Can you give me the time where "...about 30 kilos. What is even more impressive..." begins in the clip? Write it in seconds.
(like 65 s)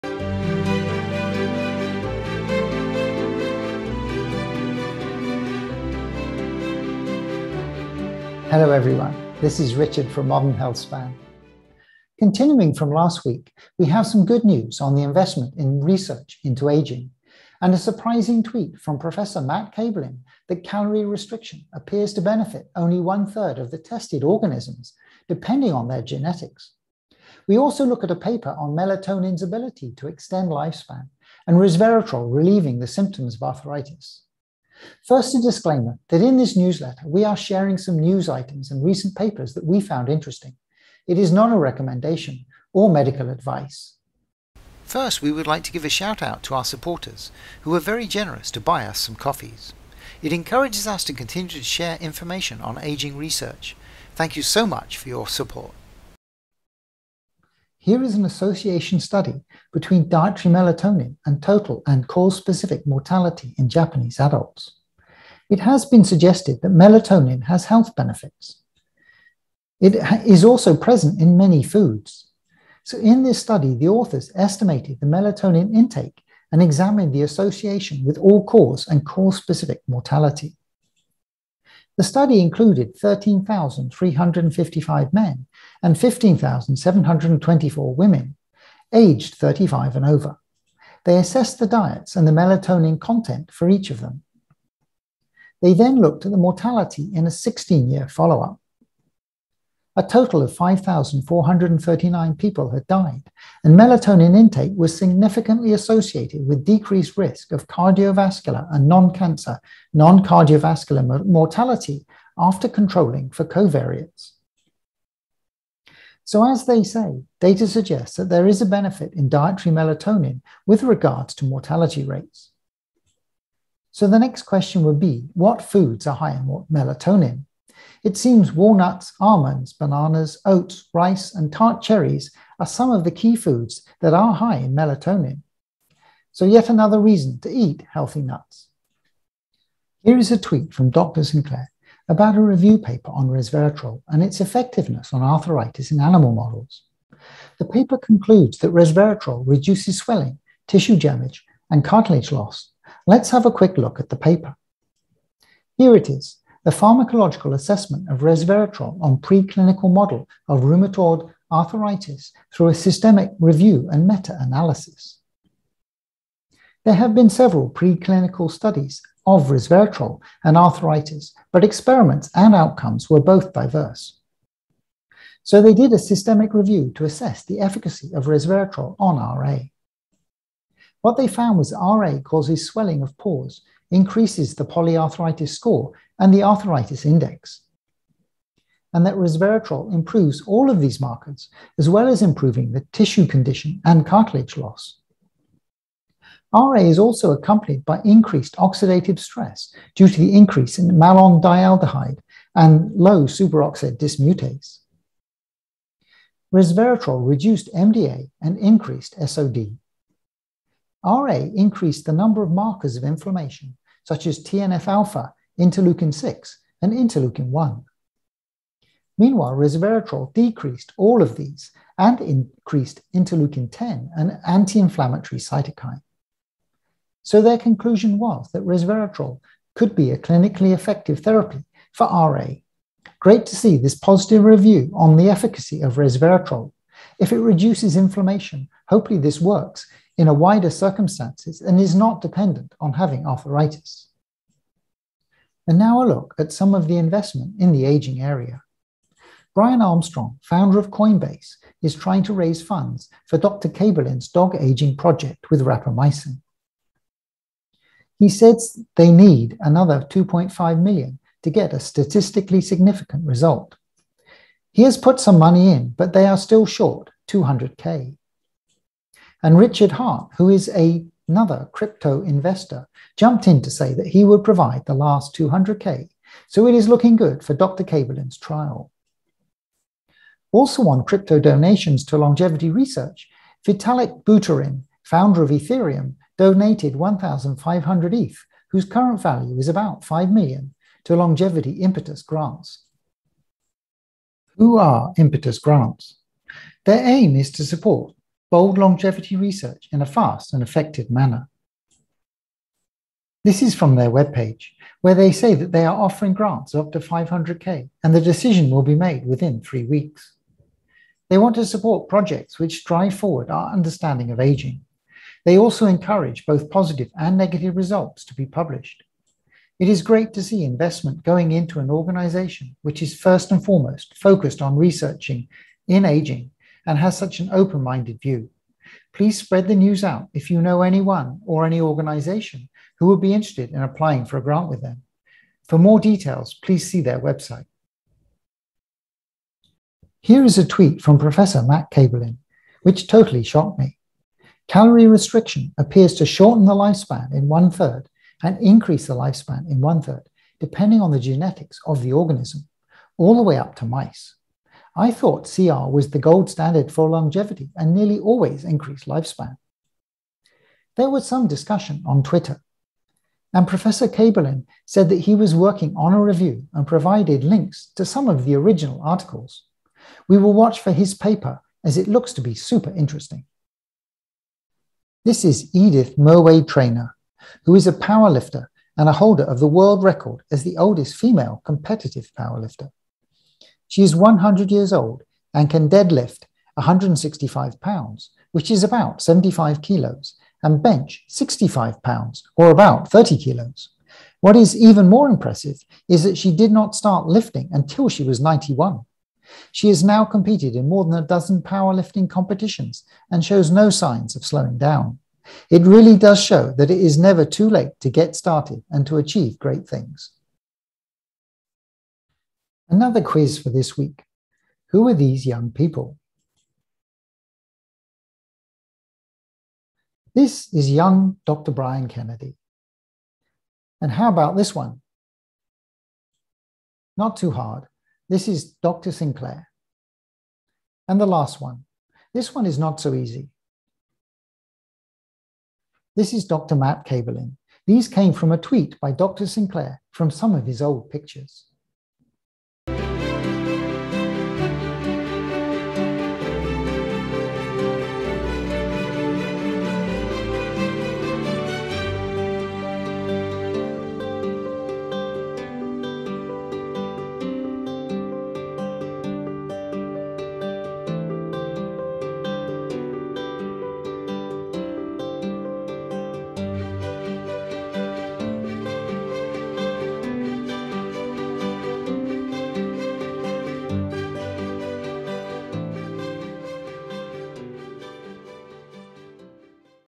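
392 s.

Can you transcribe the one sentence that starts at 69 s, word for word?
It is also present in many foods.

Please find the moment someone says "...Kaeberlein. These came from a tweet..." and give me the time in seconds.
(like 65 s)
437 s.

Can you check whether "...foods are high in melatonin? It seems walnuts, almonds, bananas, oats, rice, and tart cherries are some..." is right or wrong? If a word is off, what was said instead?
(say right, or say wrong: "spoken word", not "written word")
right.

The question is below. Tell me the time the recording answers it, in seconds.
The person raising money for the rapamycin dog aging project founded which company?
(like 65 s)
250 s.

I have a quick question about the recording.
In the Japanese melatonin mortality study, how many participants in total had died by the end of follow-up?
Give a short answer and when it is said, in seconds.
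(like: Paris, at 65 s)
5,439, at 100 s.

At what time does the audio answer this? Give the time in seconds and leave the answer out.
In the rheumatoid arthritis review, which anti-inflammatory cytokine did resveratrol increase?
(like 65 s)
223 s.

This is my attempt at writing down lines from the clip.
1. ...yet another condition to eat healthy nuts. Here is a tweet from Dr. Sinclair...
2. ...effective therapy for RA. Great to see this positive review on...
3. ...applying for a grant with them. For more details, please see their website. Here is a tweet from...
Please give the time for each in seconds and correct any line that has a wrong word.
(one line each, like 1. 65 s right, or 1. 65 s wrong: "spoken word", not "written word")
1. 136 s wrong: "reason", not "condition"
2. 230 s right
3. 333 s right.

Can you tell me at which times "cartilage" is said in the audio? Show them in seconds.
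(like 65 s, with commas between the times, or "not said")
151 s, 194 s.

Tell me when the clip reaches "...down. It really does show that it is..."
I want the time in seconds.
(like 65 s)
404 s.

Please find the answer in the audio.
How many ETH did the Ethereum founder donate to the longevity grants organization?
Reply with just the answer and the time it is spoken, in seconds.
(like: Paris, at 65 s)
1,500, at 286 s.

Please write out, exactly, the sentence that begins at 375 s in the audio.
This is Edith Murway-Traina, who is a powerlifter and a holder of the world record as the oldest female competitive powerlifter.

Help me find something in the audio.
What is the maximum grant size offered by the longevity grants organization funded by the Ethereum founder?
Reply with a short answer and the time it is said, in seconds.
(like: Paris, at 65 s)
500k, at 306 s.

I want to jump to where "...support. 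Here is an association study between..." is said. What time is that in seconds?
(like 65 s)
55 s.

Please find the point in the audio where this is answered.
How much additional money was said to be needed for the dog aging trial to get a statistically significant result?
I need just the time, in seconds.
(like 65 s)
260 s.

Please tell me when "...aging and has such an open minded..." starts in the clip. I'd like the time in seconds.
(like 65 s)
326 s.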